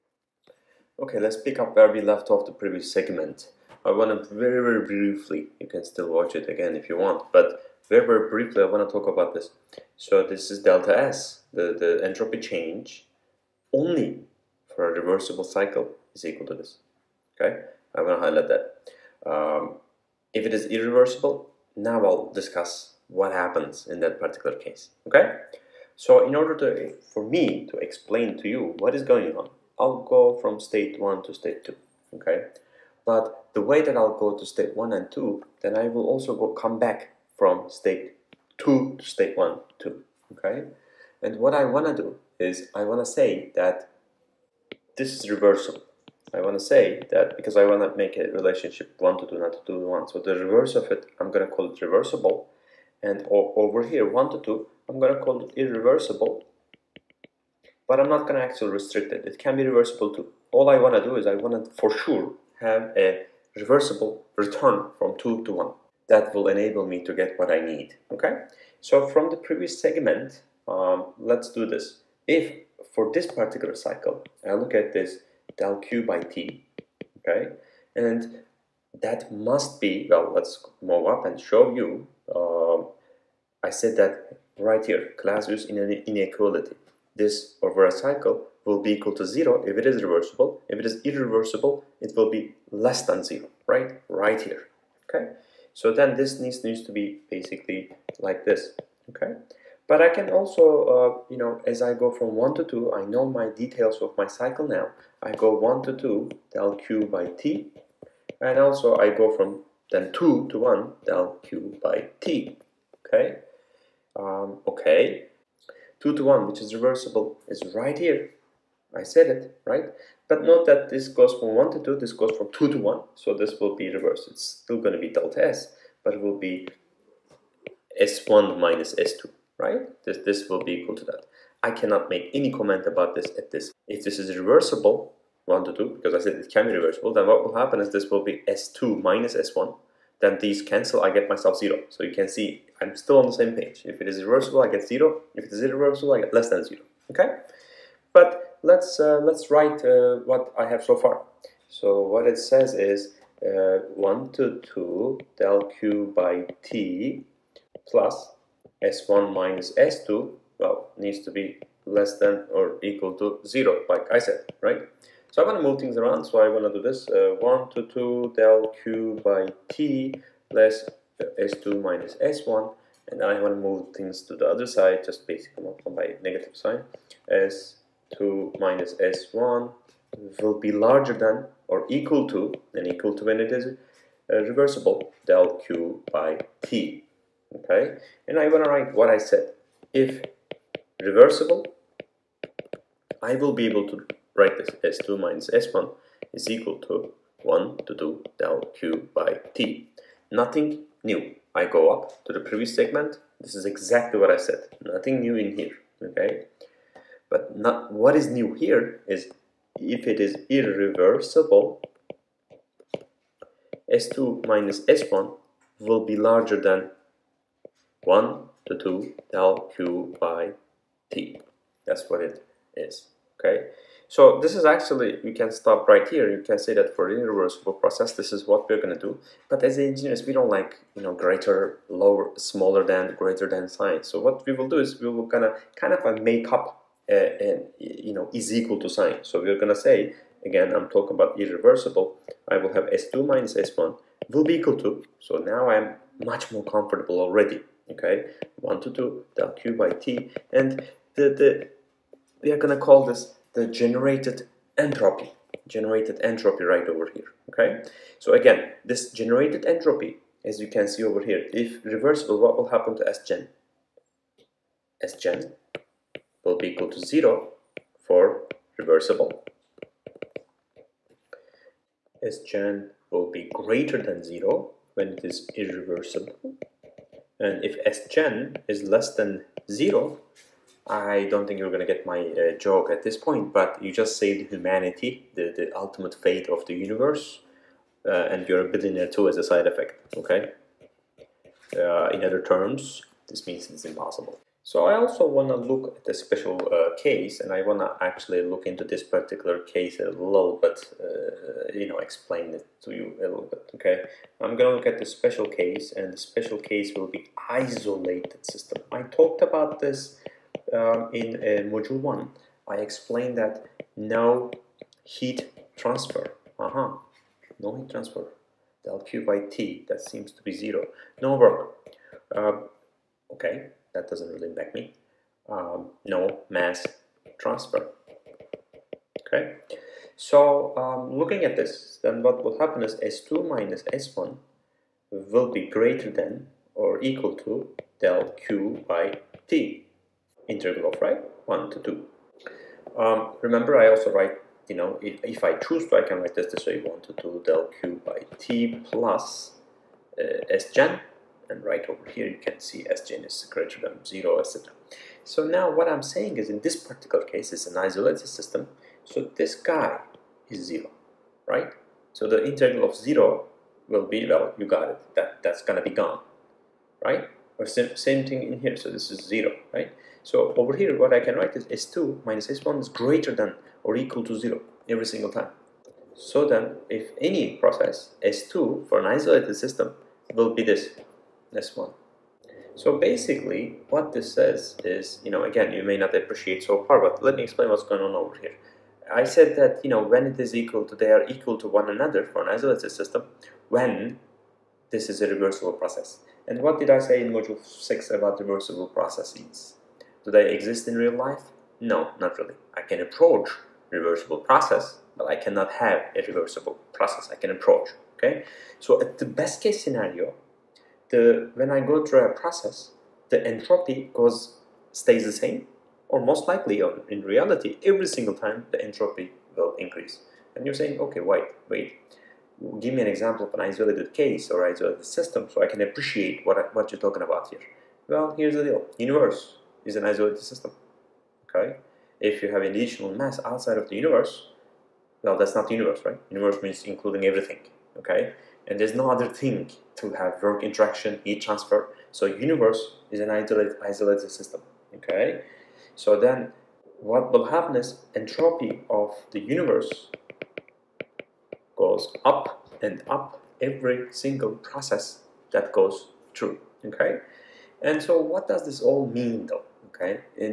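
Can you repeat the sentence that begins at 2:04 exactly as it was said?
It's still going to be delta S, but it will be S1 minus S2, right?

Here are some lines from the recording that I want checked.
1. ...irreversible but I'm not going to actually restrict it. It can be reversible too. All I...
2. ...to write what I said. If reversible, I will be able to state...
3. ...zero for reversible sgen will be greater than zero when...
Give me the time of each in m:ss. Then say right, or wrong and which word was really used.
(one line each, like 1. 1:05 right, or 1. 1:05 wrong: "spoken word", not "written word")
1. 0:55 right
2. 3:08 wrong: "write", not "state"
3. 4:26 right.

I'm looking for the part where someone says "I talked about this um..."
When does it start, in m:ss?
5:08.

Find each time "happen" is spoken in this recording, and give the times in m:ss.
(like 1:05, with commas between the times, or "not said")
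0:23, 2:17, 4:22, 5:32, 7:27.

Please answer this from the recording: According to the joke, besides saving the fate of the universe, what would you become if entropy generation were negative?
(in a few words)
a billionaire.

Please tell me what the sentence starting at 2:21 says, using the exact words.
So you can see I'm still on the same page.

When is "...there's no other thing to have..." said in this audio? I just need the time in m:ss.
7:18.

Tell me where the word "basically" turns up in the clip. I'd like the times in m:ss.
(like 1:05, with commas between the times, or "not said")
1:37, 2:55, 6:22.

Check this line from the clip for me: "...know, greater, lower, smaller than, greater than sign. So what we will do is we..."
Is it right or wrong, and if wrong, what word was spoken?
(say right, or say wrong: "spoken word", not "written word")
right.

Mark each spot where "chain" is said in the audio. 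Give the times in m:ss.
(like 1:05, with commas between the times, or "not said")
not said.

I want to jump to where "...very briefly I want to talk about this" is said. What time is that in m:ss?
0:08.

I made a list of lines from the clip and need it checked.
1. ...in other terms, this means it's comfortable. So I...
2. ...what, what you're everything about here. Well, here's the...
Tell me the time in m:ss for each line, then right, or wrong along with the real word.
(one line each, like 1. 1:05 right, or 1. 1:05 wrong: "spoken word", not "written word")
1. 4:52 wrong: "impossible", not "comfortable"
2. 7:06 wrong: "talking", not "everything".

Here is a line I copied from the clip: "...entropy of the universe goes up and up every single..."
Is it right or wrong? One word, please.
right.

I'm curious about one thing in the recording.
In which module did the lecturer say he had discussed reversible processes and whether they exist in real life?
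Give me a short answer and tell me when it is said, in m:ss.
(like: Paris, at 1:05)
module 6, at 6:37.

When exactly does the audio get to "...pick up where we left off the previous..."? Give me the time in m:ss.
0:01.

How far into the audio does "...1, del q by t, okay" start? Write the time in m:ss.
1:50.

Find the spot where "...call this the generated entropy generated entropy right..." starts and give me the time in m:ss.
4:12.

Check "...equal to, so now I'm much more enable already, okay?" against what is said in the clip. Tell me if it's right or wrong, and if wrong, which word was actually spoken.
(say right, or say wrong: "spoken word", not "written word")
wrong: "comfortable", not "enable".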